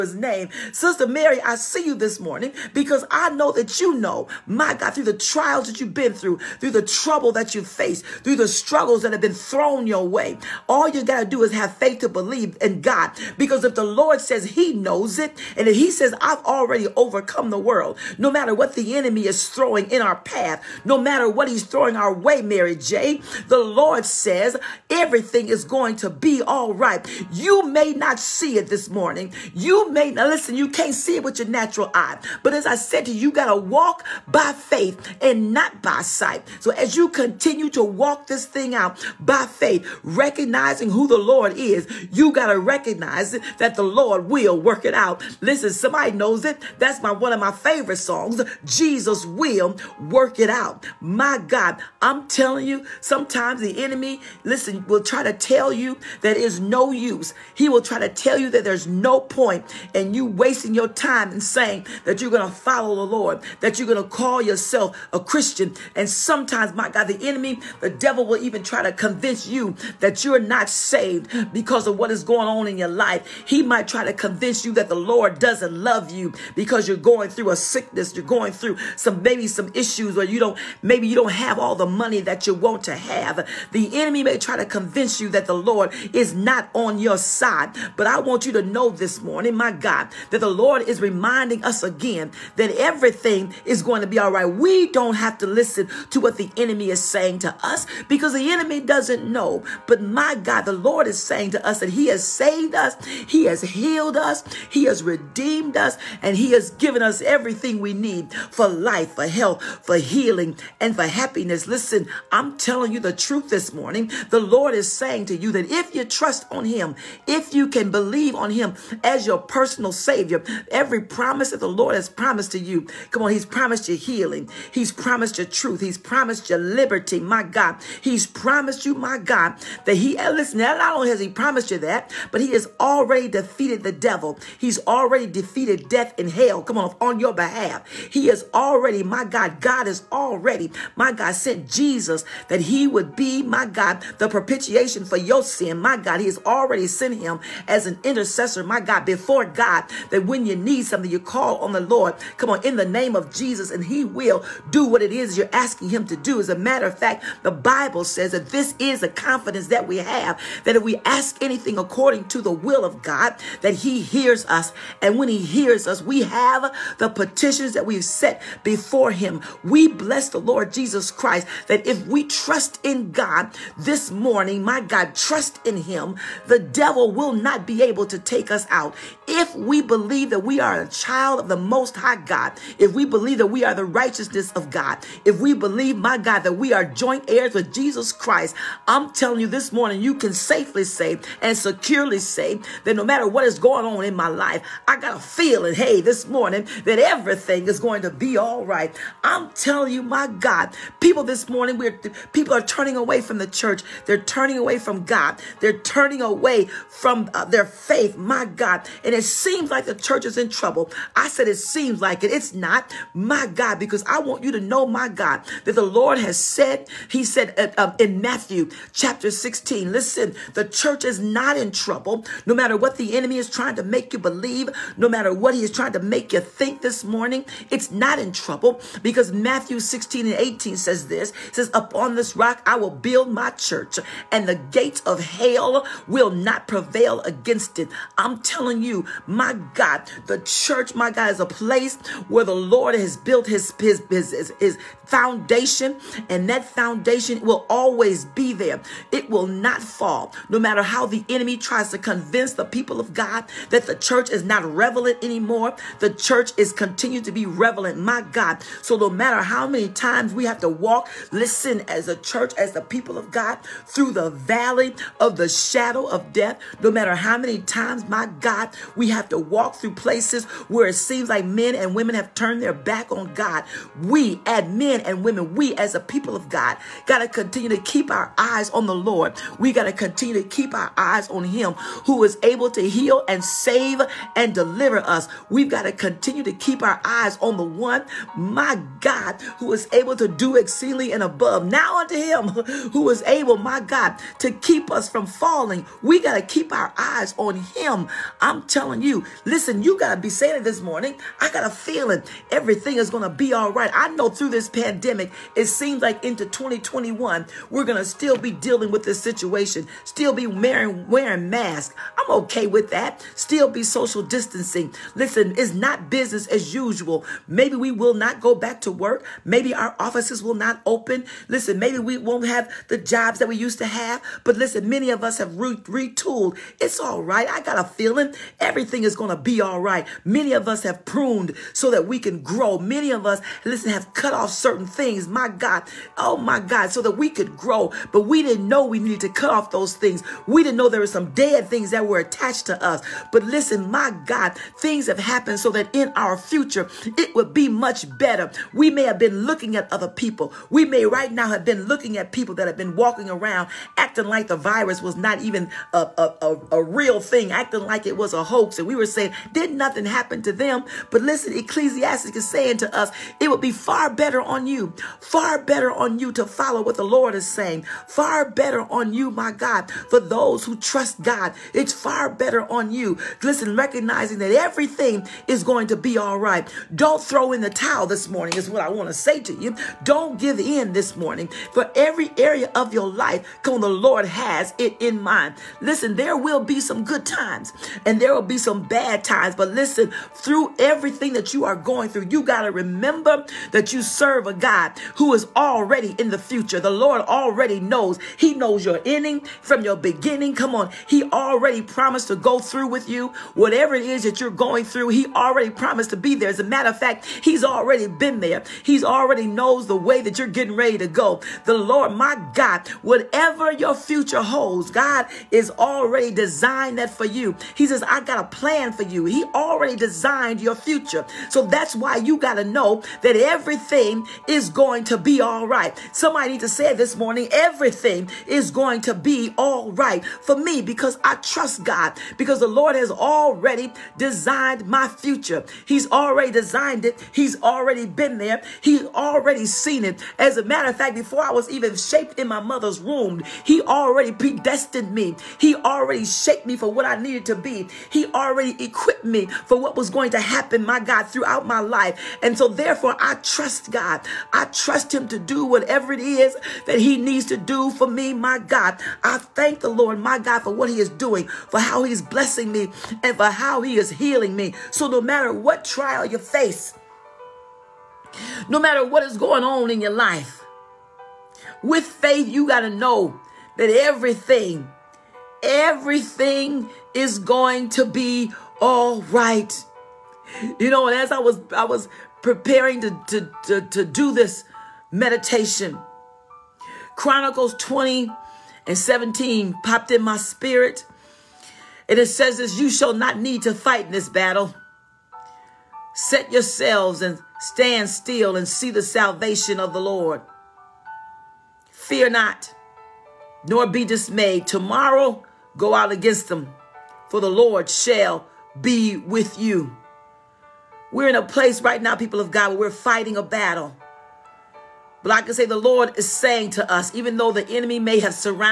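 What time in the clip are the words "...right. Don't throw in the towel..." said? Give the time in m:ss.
6:16.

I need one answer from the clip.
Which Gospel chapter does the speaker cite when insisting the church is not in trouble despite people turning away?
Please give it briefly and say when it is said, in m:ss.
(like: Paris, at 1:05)
Matthew 16, at 3:38.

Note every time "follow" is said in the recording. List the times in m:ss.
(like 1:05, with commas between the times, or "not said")
1:02, 6:06.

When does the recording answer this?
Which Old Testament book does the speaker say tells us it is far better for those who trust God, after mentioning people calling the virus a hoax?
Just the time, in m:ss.
6:01.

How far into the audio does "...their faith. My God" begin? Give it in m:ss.
3:27.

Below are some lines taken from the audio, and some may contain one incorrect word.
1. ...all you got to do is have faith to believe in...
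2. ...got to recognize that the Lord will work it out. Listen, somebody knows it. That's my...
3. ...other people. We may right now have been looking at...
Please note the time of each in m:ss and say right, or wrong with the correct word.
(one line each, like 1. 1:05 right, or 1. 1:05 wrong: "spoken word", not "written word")
1. 0:10 right
2. 0:42 right
3. 5:49 right.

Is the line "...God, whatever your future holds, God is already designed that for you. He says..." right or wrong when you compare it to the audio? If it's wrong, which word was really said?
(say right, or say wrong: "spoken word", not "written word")
right.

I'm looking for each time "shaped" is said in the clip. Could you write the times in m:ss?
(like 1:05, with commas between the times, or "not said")
7:21, 7:26.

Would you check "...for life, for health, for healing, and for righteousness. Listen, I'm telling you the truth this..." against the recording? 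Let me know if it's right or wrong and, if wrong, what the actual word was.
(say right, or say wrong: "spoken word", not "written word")
wrong: "happiness", not "righteousness".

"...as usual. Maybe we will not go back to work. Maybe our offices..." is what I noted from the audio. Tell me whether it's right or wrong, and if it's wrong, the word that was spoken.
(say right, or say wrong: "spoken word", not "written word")
right.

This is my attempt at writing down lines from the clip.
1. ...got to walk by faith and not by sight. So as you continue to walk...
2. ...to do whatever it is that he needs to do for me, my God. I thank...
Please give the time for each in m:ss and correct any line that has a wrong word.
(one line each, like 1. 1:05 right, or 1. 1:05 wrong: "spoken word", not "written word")
1. 0:33 right
2. 7:35 right.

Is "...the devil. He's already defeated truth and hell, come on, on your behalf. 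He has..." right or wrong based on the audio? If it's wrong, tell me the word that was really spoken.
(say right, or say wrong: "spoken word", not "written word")
wrong: "death", not "truth".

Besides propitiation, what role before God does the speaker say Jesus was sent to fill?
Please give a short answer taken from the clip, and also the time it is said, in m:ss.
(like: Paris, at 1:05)
intercessor, at 2:28.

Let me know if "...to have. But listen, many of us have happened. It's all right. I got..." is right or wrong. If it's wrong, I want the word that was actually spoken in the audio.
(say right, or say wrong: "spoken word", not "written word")
wrong: "retooled", not "happened".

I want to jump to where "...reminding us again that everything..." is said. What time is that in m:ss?
1:31.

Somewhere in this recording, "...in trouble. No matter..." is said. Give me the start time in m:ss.
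3:41.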